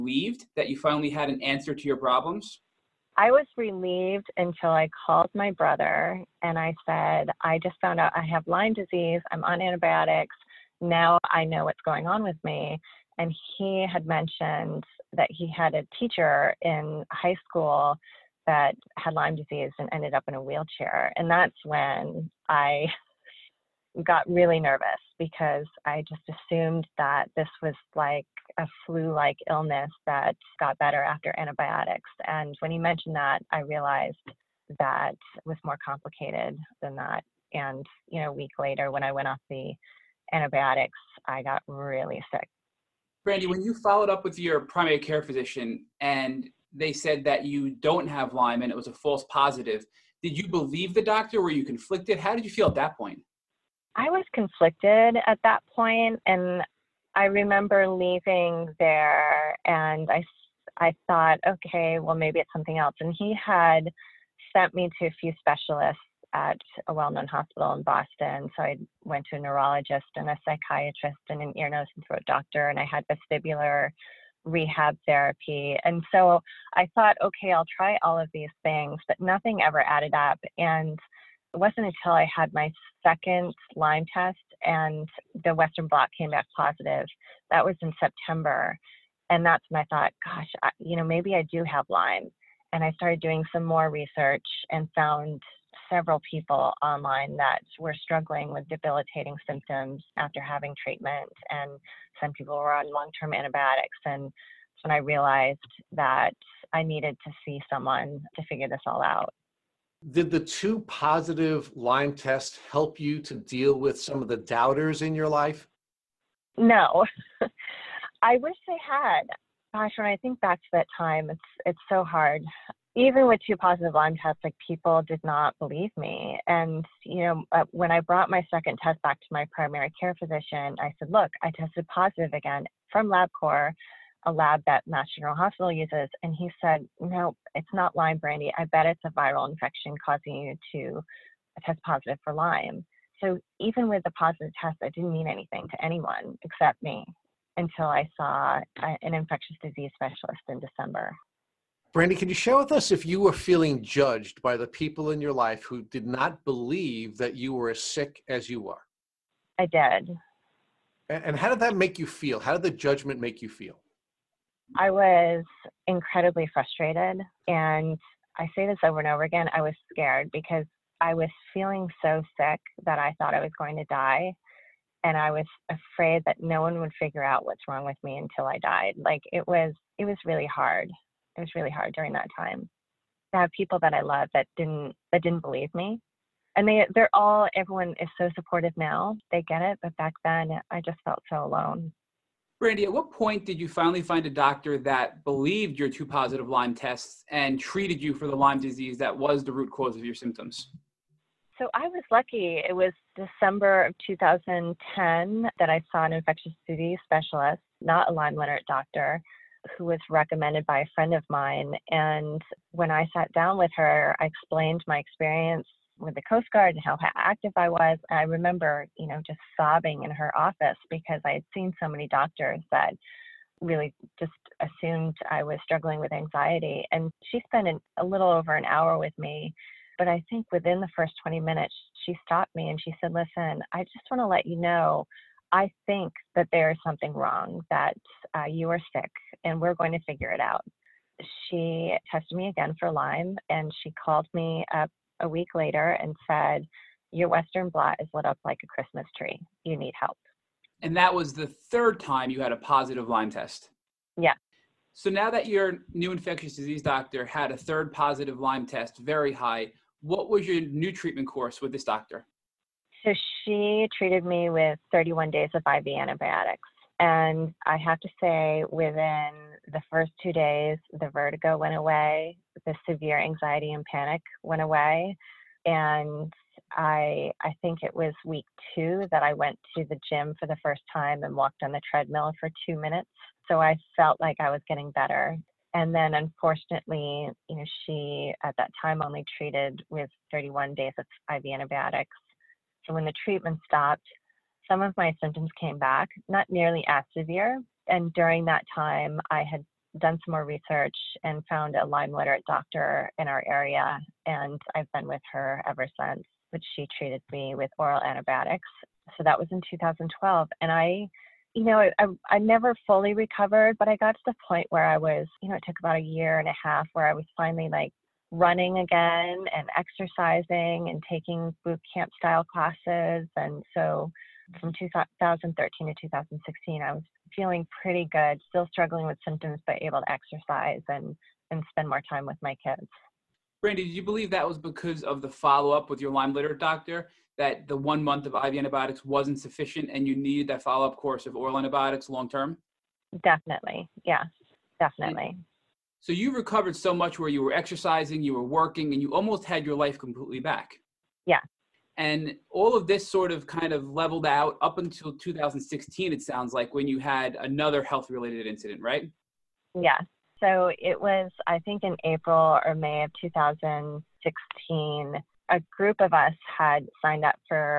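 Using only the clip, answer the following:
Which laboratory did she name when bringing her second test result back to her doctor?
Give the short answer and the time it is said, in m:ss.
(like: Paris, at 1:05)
LabCorp, at 2:13.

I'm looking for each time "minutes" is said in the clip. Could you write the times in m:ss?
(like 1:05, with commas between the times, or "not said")
3:51, 4:42.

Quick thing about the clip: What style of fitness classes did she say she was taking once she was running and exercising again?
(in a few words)
Boot camp.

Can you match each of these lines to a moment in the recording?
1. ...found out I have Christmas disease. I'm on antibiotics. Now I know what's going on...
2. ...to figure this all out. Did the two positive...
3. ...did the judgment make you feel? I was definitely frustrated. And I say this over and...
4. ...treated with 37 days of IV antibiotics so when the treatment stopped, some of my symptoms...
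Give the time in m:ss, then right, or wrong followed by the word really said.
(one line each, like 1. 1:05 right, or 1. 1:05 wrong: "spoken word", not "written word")
1. 0:07 wrong: "Lyme", not "Christmas"
2. 1:48 right
3. 2:42 wrong: "incredibly", not "definitely"
4. 4:49 wrong: "31", not "37".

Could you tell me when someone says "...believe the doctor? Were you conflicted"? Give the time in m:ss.
0:50.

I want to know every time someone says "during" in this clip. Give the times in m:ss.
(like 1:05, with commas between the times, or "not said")
3:01, 4:58.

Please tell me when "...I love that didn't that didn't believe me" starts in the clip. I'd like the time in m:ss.
3:03.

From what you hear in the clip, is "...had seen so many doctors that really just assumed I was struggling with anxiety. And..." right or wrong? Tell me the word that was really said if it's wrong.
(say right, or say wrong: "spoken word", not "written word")
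right.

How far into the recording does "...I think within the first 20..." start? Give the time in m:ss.
3:50.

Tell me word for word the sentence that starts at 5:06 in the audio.
But she treated me with oral antibiotics.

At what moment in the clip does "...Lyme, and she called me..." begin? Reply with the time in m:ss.
4:02.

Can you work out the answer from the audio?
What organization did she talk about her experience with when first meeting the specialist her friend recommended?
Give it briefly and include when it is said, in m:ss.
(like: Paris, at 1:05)
Coast Guard, at 3:36.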